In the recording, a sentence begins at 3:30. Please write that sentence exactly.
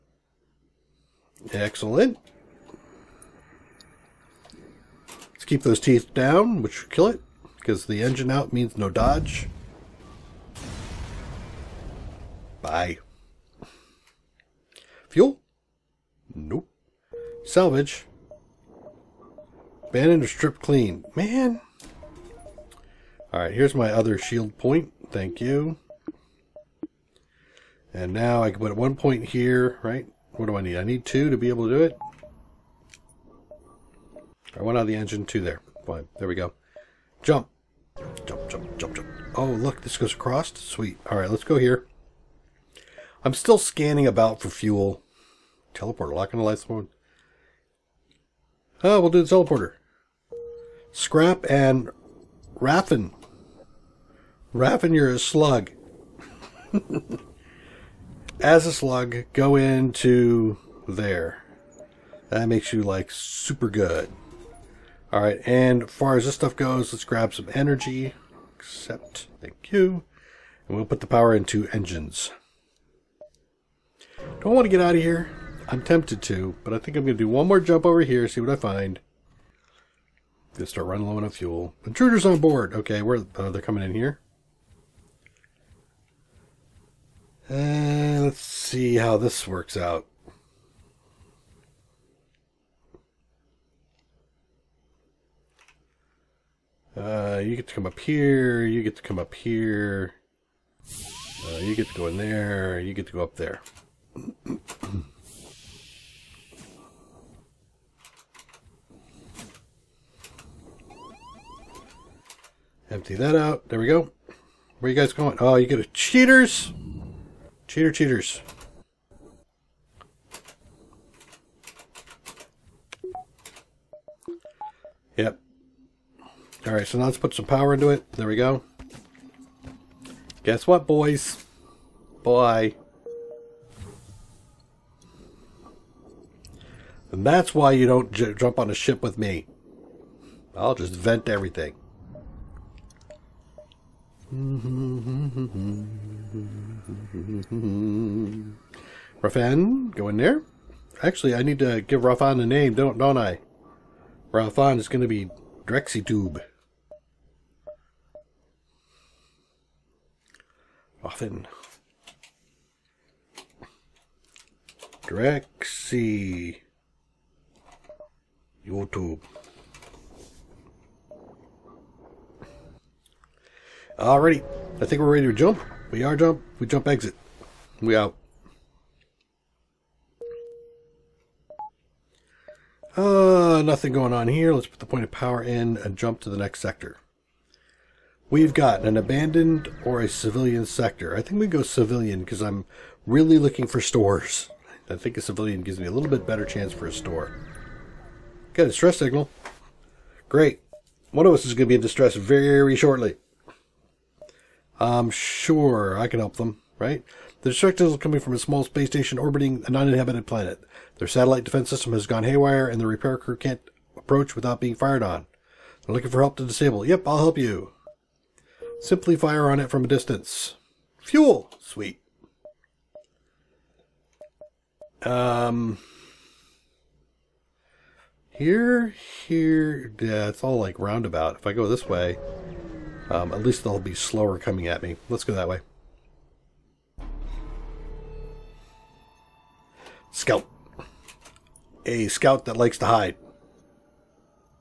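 Their satellite defense system has gone haywire, and the repair crew can't approach without being fired on.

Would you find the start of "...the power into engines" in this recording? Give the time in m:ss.
1:11.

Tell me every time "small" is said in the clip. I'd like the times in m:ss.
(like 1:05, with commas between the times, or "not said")
3:28.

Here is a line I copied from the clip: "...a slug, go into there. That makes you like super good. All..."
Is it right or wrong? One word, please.
right.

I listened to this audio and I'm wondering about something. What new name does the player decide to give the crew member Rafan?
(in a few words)
Tube.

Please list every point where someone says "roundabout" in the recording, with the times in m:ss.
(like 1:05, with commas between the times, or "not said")
3:50.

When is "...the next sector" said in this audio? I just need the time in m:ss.
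3:06.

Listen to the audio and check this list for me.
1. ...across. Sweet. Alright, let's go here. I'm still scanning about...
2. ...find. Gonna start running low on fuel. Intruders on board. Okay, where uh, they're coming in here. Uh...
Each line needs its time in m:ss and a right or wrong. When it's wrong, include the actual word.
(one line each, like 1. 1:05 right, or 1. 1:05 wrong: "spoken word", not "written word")
1. 0:40 right
2. 1:18 right.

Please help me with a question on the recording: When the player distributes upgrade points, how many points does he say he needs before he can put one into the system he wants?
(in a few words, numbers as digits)
2.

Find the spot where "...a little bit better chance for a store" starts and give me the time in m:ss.
3:15.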